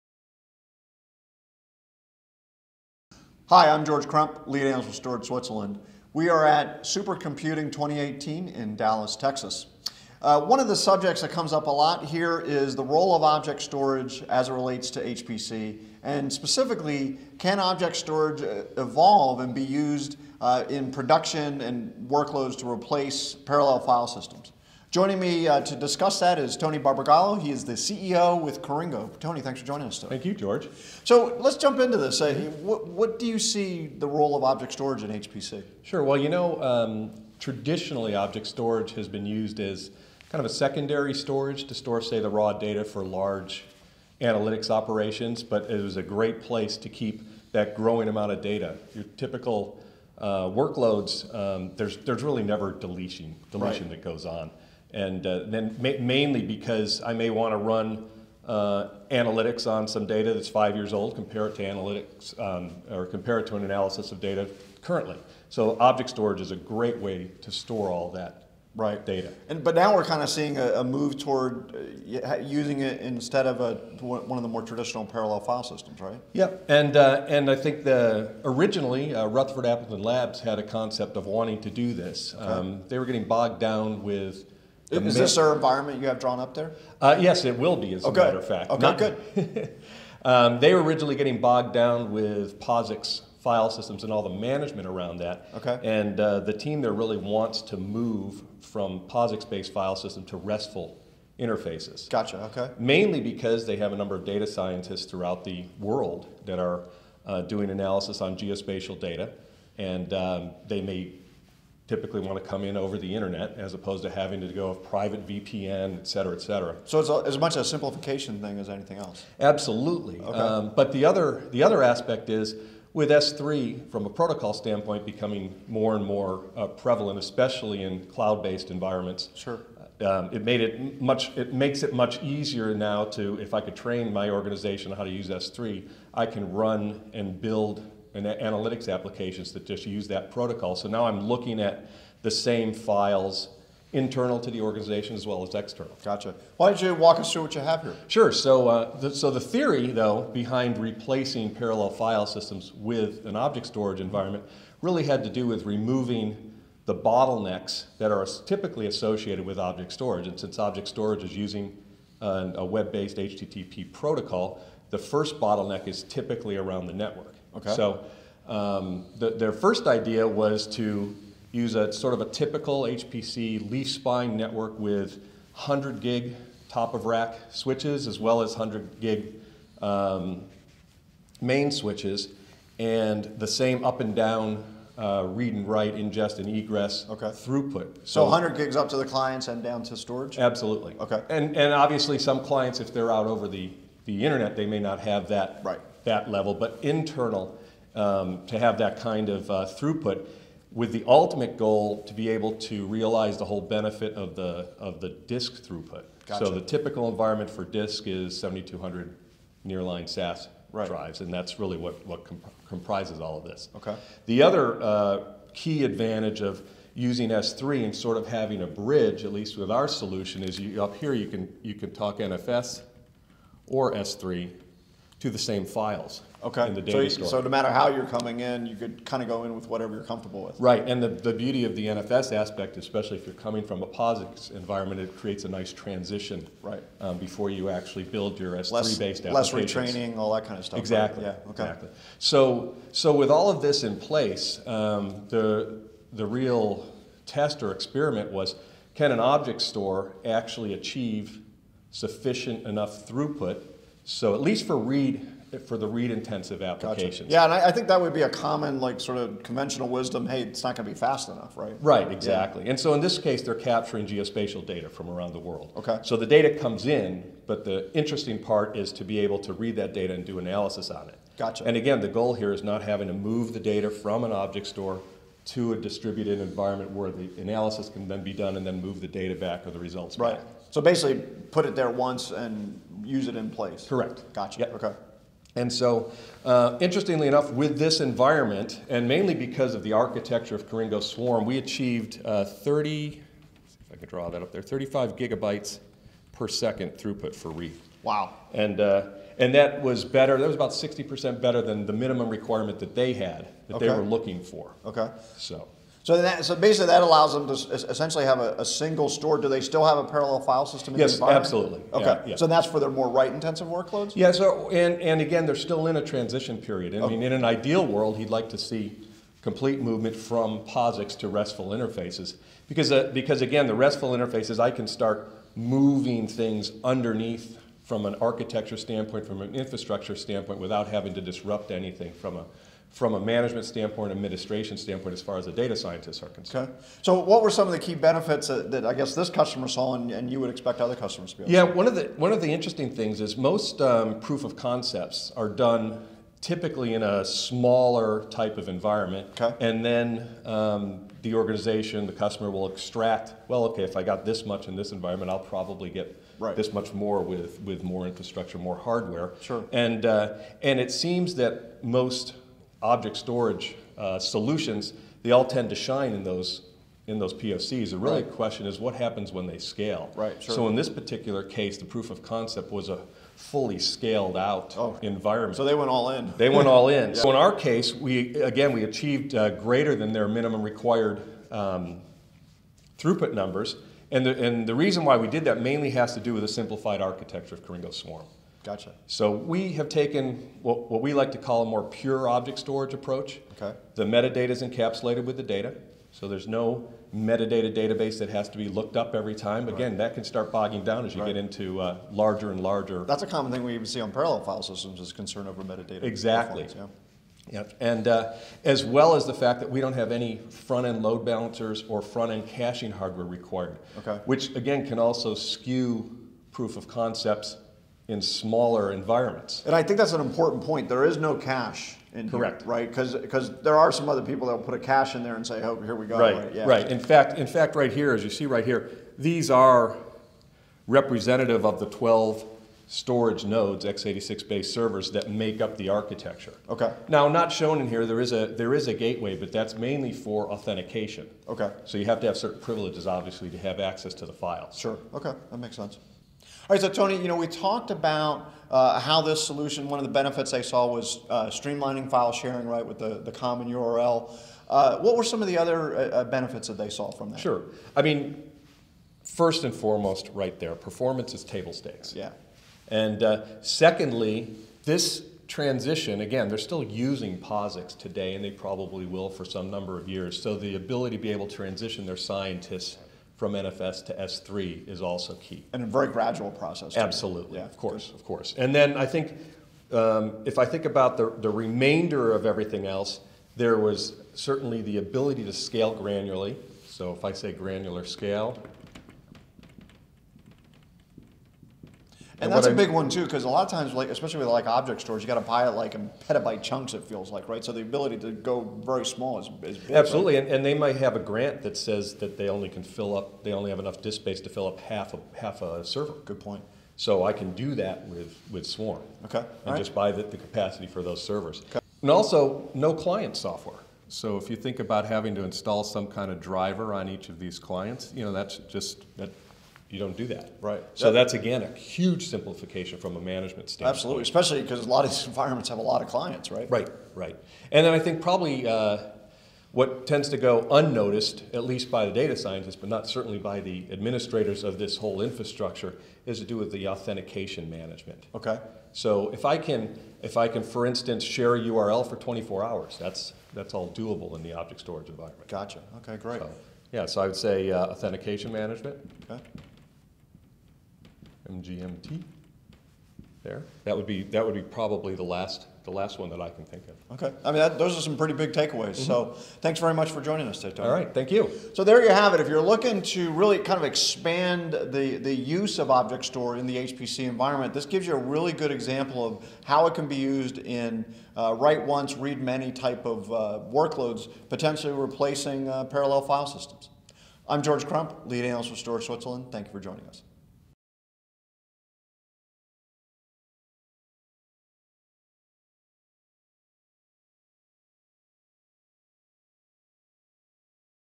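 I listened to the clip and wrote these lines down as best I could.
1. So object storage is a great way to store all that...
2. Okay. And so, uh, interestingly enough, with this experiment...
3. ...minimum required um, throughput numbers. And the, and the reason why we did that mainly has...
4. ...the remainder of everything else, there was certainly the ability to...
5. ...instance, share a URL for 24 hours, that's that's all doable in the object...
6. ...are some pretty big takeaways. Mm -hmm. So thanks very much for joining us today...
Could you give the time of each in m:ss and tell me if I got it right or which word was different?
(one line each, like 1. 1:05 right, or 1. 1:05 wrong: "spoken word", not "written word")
1. 1:05 right
2. 4:44 wrong: "environment", not "experiment"
3. 6:20 right
4. 8:01 right
5. 9:00 right
6. 9:17 right.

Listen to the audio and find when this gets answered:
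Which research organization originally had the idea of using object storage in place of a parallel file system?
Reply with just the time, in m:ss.
1:19.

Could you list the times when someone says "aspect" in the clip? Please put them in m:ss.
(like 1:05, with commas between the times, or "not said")
2:01, 3:52.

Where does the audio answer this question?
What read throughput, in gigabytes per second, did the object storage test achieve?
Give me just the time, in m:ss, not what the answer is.
4:54.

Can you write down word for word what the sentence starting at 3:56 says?
Um, before you actually build your S3-based applications.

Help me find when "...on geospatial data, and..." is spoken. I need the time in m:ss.
1:48.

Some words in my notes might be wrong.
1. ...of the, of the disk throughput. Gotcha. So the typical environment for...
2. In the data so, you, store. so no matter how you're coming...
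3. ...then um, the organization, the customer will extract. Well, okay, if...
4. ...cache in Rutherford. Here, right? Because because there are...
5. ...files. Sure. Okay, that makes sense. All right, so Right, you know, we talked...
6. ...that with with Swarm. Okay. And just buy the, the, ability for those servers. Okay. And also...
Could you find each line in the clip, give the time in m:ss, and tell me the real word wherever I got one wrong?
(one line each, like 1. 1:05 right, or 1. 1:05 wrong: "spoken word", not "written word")
1. 3:24 right
2. 3:46 right
3. 5:49 right
4. 7:01 wrong: "Correct", not "Rutherford"
5. 7:24 wrong: "Tony", not "Right"
6. 8:27 wrong: "capacity", not "ability".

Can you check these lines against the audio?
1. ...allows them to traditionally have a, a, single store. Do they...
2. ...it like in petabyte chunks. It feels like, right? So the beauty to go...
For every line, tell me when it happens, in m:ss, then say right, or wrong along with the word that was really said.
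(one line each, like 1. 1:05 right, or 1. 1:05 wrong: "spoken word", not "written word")
1. 5:07 wrong: "essentially", not "traditionally"
2. 8:15 wrong: "ability", not "beauty".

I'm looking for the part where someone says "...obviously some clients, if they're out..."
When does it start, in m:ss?
3:11.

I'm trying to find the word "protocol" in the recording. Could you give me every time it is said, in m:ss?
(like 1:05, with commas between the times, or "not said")
2:04, 2:20, 2:43.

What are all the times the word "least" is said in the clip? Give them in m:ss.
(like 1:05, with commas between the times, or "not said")
3:39, 4:14, 8:51.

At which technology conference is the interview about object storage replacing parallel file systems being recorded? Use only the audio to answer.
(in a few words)
Supercomputing 2018.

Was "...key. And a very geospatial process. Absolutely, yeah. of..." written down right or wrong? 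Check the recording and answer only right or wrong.
wrong.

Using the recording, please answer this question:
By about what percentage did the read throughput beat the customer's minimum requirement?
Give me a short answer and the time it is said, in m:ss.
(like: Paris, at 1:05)
60%, at 5:00.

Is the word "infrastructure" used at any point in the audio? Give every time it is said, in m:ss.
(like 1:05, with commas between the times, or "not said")
5:29, 5:58, 8:55.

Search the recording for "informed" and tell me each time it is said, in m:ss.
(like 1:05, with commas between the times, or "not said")
not said.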